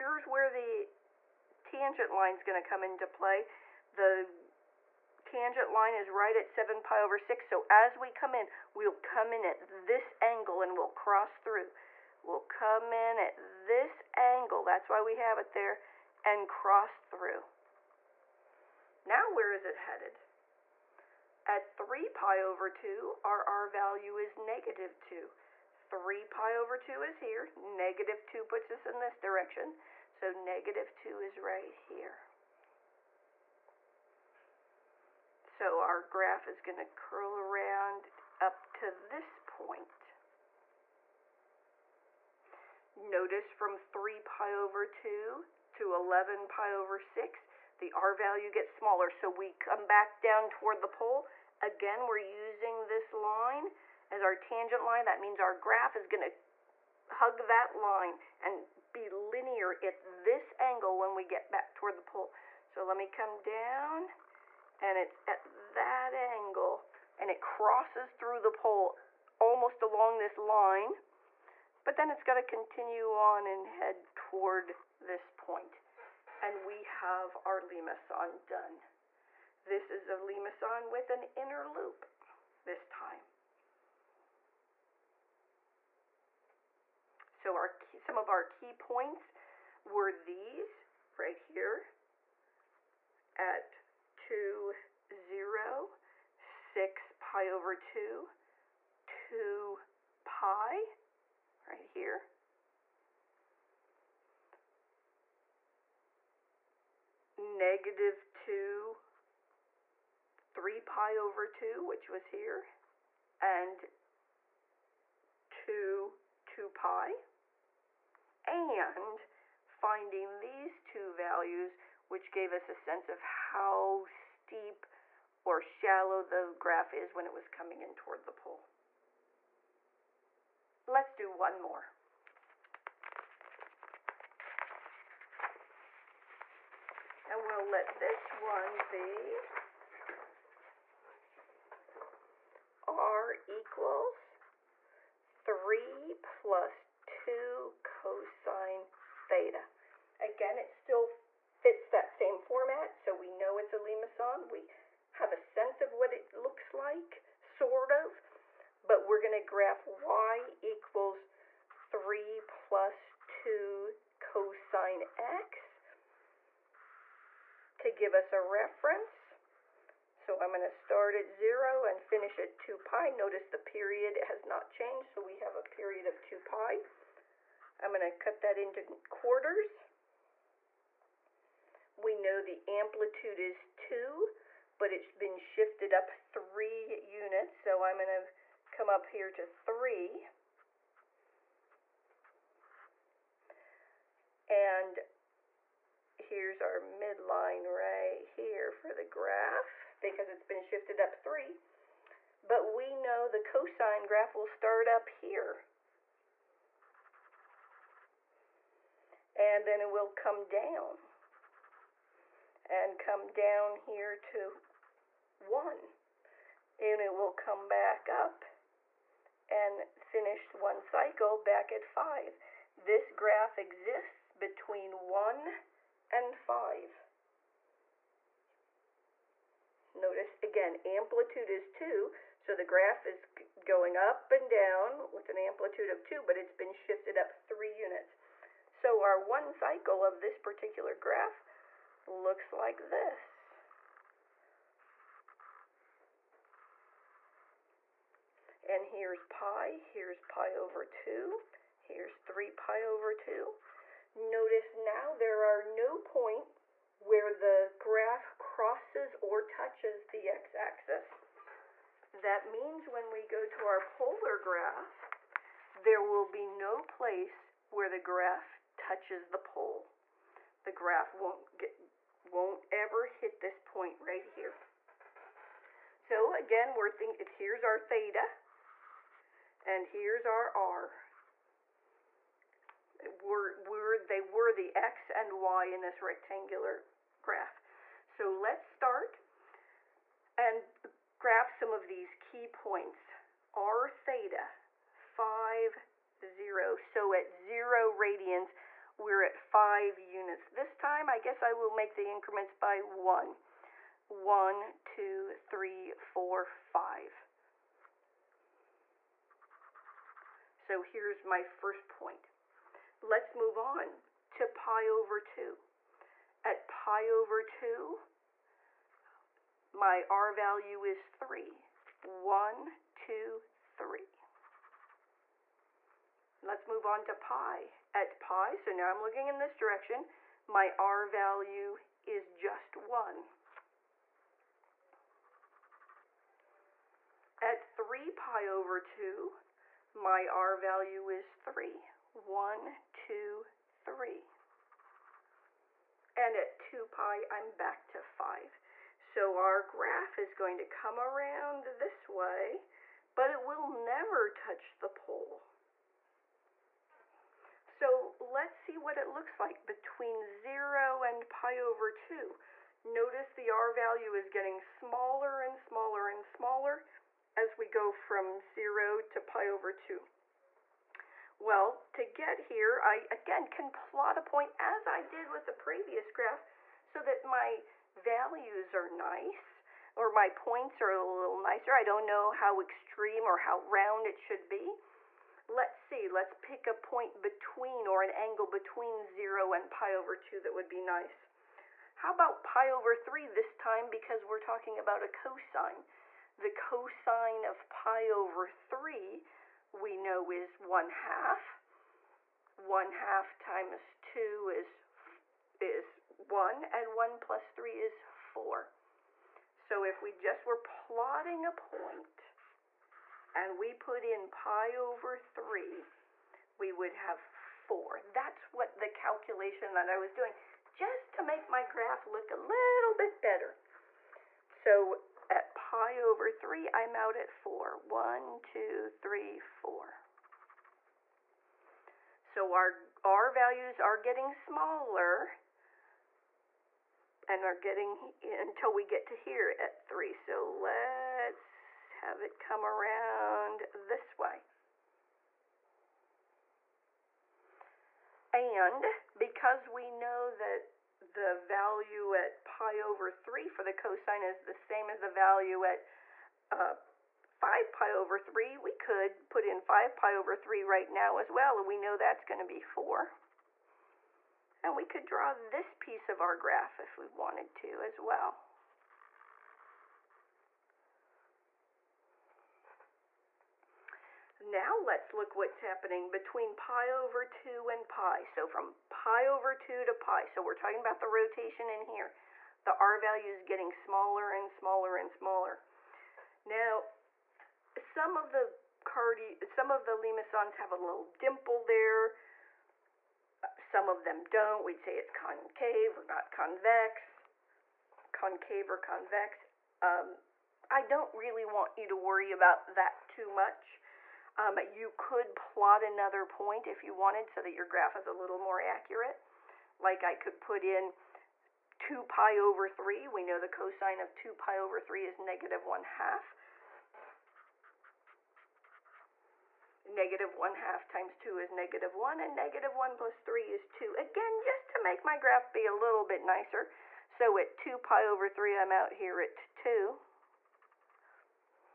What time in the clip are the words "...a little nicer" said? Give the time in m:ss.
6:20.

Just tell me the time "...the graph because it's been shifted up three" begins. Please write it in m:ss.
3:18.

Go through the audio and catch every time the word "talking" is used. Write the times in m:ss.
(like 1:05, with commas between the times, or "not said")
6:34, 8:00.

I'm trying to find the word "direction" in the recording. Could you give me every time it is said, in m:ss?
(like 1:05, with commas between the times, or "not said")
0:29, 5:29.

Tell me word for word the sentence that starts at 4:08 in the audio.
And here's pi, here's pi over 2, here's 3 pi over 2.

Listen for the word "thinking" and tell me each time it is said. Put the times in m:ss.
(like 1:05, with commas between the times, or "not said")
4:36.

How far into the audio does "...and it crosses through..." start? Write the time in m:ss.
1:07.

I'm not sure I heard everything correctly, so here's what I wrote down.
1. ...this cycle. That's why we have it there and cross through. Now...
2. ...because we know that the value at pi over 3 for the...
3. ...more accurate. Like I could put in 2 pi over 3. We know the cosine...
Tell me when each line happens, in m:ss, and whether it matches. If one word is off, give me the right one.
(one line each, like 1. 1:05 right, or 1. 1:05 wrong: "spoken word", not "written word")
1. 0:13 wrong: "angle", not "cycle"
2. 7:29 right
3. 8:28 right.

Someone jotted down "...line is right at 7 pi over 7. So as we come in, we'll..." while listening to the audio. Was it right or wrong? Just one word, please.
wrong.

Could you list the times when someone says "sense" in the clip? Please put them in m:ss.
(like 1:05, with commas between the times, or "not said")
2:02, 2:35.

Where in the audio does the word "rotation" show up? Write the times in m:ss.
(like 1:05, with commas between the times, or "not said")
8:01.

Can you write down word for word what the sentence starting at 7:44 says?
And we could draw this piece of our graph if we wanted to as well.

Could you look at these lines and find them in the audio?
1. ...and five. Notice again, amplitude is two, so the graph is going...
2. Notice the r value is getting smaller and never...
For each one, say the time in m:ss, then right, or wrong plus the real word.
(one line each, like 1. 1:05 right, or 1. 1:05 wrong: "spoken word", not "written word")
1. 3:46 right
2. 6:02 wrong: "smaller", not "never".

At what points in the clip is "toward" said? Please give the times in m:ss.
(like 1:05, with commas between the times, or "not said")
0:50, 1:01, 1:14, 2:07.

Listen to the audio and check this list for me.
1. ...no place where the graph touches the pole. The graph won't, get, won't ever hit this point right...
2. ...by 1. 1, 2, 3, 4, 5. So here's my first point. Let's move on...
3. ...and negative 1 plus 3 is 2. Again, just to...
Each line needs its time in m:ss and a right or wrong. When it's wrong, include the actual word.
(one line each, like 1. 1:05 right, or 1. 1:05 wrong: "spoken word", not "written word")
1. 4:26 right
2. 5:02 right
3. 8:42 right.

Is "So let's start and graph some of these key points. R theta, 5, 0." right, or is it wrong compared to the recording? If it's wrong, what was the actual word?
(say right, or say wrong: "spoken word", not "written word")
right.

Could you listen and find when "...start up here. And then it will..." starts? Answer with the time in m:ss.
3:24.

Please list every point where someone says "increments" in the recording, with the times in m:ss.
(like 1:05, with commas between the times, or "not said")
5:02.